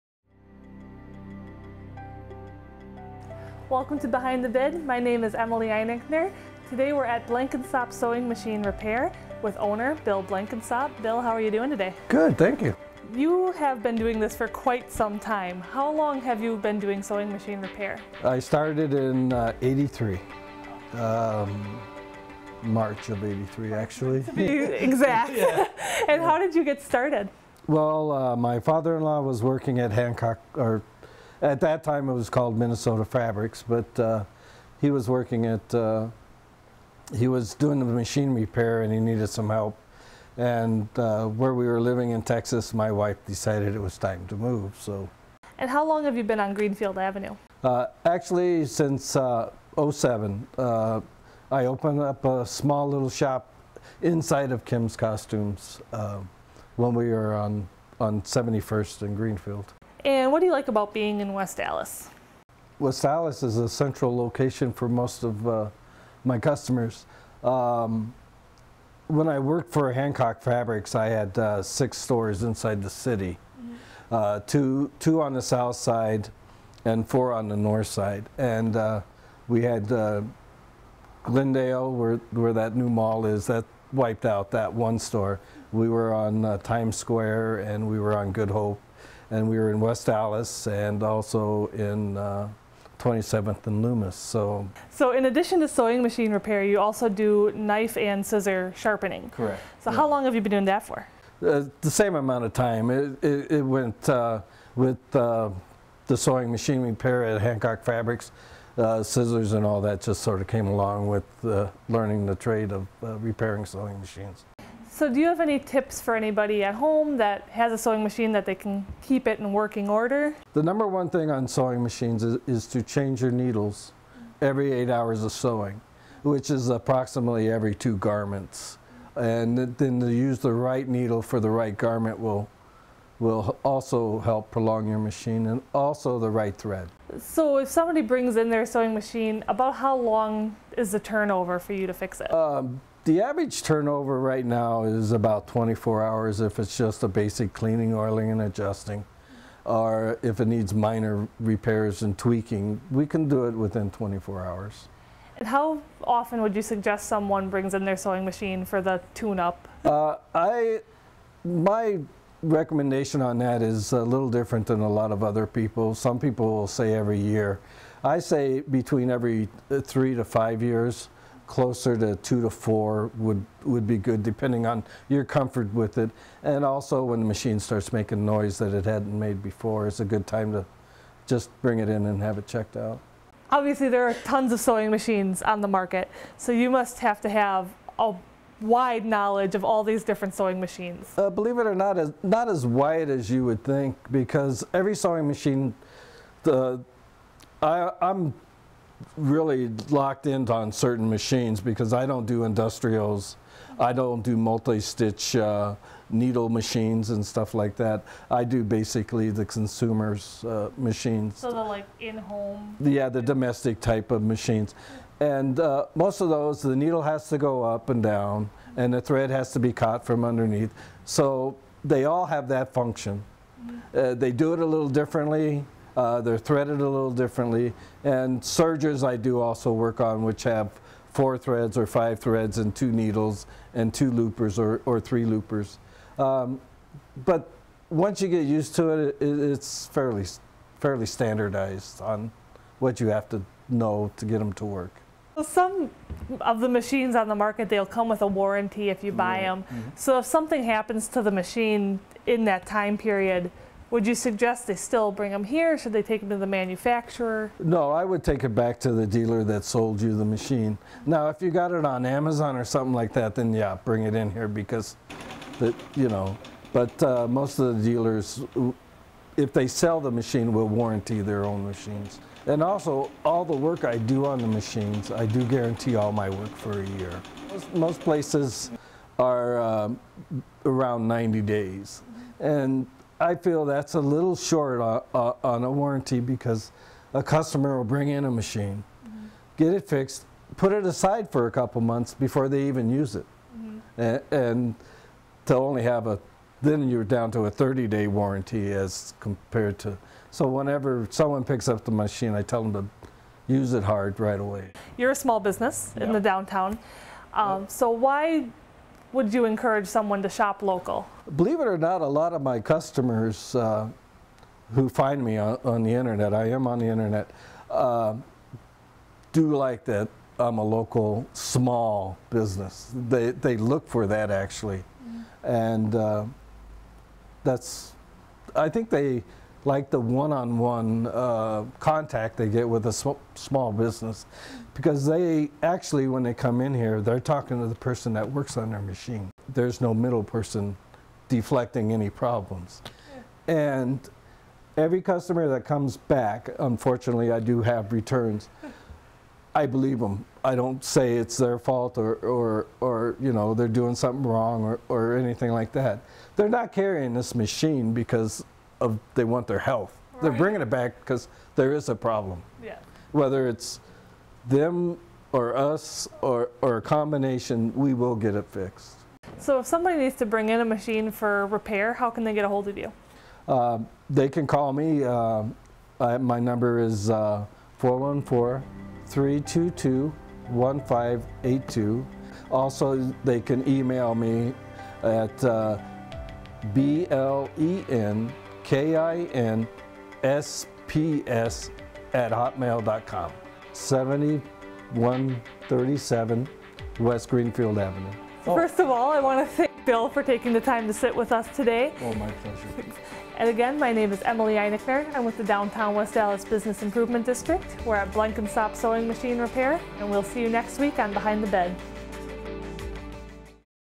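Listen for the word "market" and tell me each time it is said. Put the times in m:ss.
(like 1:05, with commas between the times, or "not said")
3:05, 4:07.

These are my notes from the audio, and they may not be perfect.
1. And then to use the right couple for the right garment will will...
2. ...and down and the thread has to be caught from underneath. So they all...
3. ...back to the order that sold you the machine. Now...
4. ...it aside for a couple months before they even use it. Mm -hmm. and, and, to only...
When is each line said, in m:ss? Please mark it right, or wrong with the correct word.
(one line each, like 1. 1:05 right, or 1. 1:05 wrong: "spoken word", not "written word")
1. 2:09 wrong: "needle", not "couple"
2. 3:37 right
3. 4:18 wrong: "dealer", not "order"
4. 4:50 right.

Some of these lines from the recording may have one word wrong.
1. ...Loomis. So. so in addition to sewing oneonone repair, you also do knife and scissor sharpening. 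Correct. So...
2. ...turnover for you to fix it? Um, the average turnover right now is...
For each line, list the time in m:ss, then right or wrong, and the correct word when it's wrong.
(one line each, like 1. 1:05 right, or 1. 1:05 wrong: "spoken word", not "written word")
1. 1:33 wrong: "machine", not "oneonone"
2. 2:20 right.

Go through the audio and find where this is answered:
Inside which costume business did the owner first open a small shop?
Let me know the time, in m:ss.
0:54.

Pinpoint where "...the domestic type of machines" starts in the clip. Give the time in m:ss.
3:33.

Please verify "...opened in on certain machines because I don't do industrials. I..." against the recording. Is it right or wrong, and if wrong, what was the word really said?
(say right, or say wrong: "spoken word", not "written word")
wrong: "locked", not "opened".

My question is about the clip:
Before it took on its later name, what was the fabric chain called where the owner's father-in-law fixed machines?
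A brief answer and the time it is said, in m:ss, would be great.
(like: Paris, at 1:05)
Minnesota Fabrics, at 0:32.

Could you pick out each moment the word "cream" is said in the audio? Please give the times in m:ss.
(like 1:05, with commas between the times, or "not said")
not said.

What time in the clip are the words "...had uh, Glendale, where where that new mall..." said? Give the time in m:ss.
1:19.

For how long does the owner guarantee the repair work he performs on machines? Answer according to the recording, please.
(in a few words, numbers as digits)
1 year.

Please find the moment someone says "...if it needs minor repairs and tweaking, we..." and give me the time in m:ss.
2:30.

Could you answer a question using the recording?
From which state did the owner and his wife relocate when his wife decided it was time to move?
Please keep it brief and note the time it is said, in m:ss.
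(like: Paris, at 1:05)
Texas, at 0:42.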